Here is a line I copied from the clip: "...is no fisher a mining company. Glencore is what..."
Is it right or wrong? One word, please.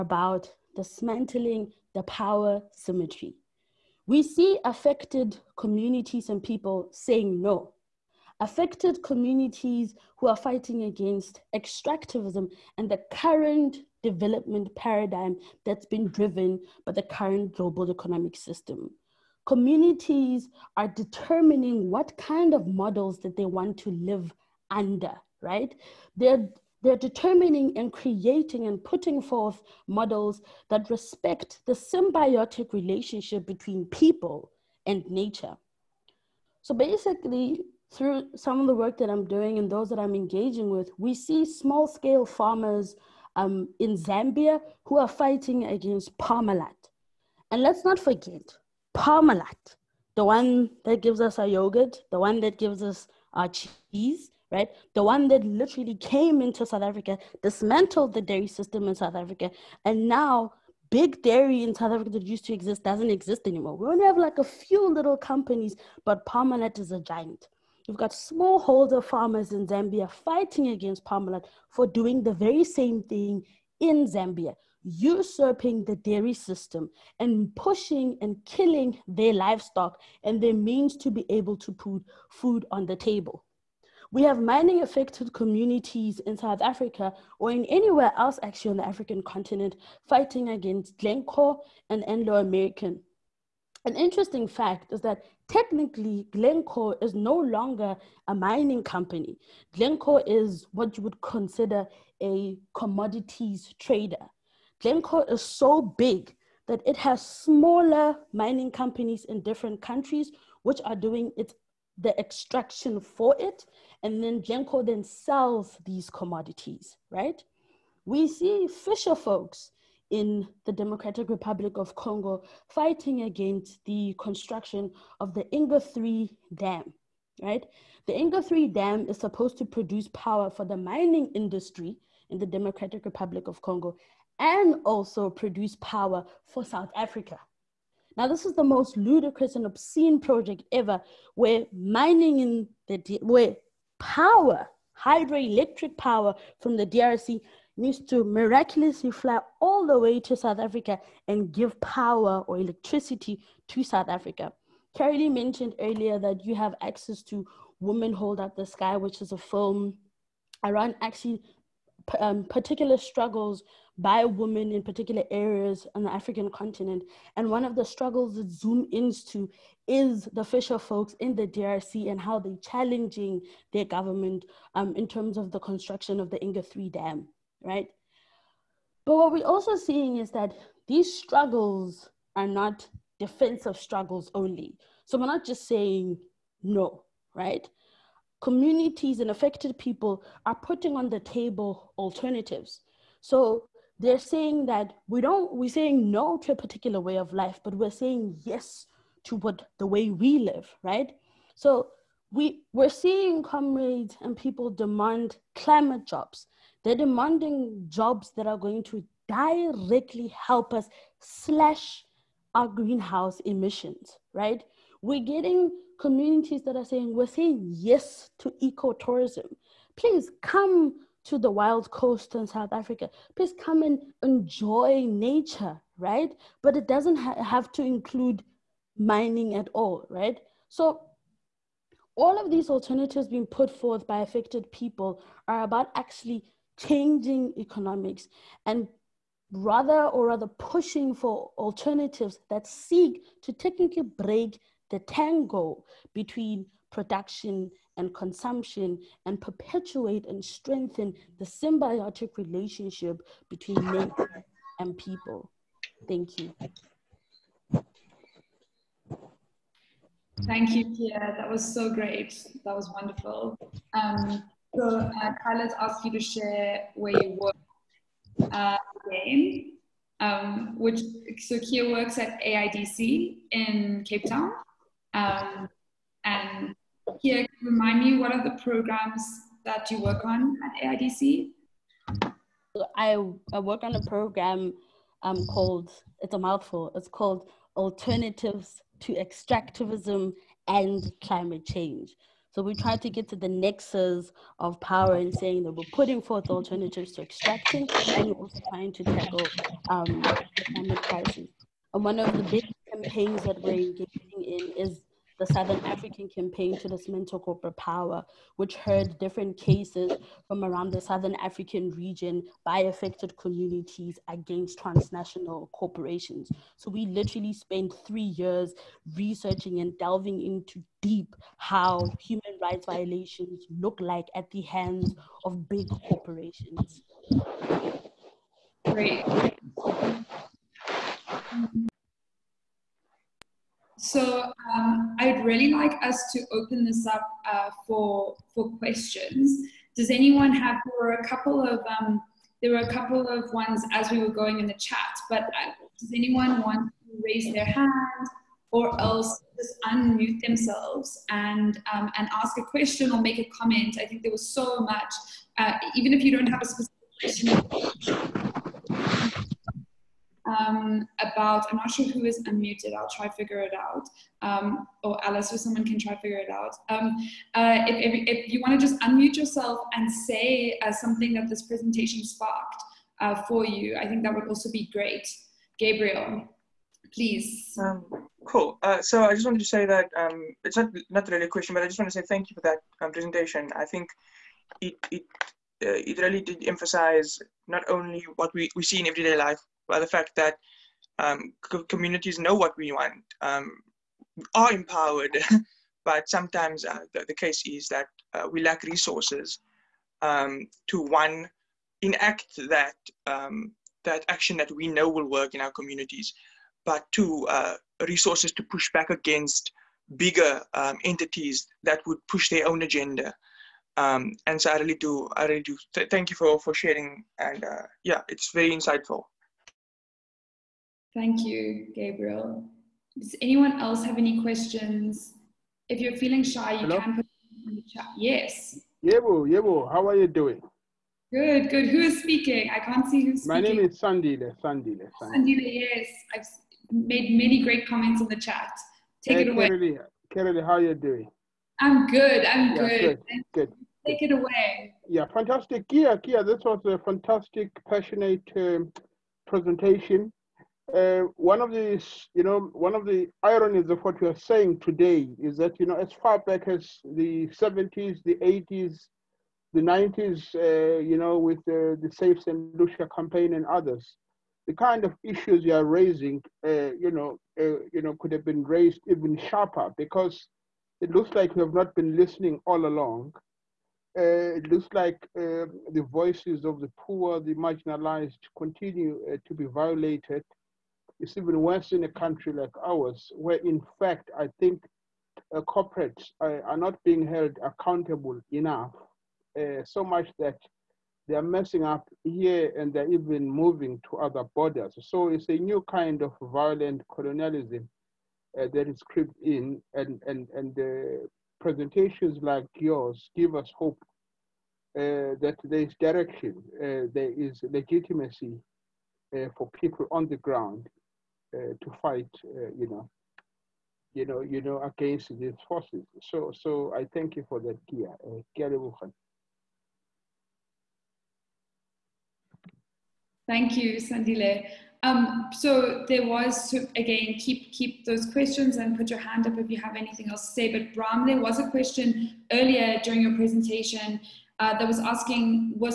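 wrong.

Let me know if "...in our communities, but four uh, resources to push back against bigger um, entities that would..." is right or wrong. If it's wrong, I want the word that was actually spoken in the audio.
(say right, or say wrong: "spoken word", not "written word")
wrong: "two", not "four".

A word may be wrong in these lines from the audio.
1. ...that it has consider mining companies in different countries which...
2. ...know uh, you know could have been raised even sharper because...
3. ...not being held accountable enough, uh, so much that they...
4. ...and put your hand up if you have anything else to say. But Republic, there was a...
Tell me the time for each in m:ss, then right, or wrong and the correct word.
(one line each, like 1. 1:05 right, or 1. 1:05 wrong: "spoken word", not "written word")
1. 1:46 wrong: "smaller", not "consider"
2. 7:47 right
3. 8:06 right
4. 8:48 wrong: "Bram", not "Republic".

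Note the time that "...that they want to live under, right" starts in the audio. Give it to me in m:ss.
0:23.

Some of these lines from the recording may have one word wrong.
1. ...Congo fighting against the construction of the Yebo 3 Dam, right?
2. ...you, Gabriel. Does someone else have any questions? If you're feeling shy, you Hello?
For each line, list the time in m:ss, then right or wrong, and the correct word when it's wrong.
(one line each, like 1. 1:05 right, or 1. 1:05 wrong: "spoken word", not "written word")
1. 2:01 wrong: "Inga", not "Yebo"
2. 7:01 wrong: "anyone", not "someone".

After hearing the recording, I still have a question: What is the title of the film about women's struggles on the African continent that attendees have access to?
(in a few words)
Women Hold Up the Sky.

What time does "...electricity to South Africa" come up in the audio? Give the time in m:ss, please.
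2:32.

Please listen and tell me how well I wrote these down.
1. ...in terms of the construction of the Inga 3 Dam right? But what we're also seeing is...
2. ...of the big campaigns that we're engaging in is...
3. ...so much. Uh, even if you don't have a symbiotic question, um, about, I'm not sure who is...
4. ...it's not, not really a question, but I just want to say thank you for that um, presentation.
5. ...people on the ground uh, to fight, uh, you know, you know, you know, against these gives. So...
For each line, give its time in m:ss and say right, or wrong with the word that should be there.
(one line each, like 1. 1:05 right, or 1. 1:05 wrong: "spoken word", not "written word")
1. 2:54 right
2. 5:02 right
3. 5:54 wrong: "specific", not "symbiotic"
4. 6:20 right
5. 8:29 wrong: "forces", not "gives".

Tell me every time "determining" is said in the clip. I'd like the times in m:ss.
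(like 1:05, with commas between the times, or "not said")
0:20, 0:26.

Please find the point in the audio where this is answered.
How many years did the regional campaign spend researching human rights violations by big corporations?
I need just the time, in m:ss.
5:18.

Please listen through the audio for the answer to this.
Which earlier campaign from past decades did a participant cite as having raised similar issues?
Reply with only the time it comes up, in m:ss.
7:42.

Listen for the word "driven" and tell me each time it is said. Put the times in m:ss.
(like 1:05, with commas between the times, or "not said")
0:16.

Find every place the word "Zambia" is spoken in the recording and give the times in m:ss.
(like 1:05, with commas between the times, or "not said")
0:43, 1:09, 1:14.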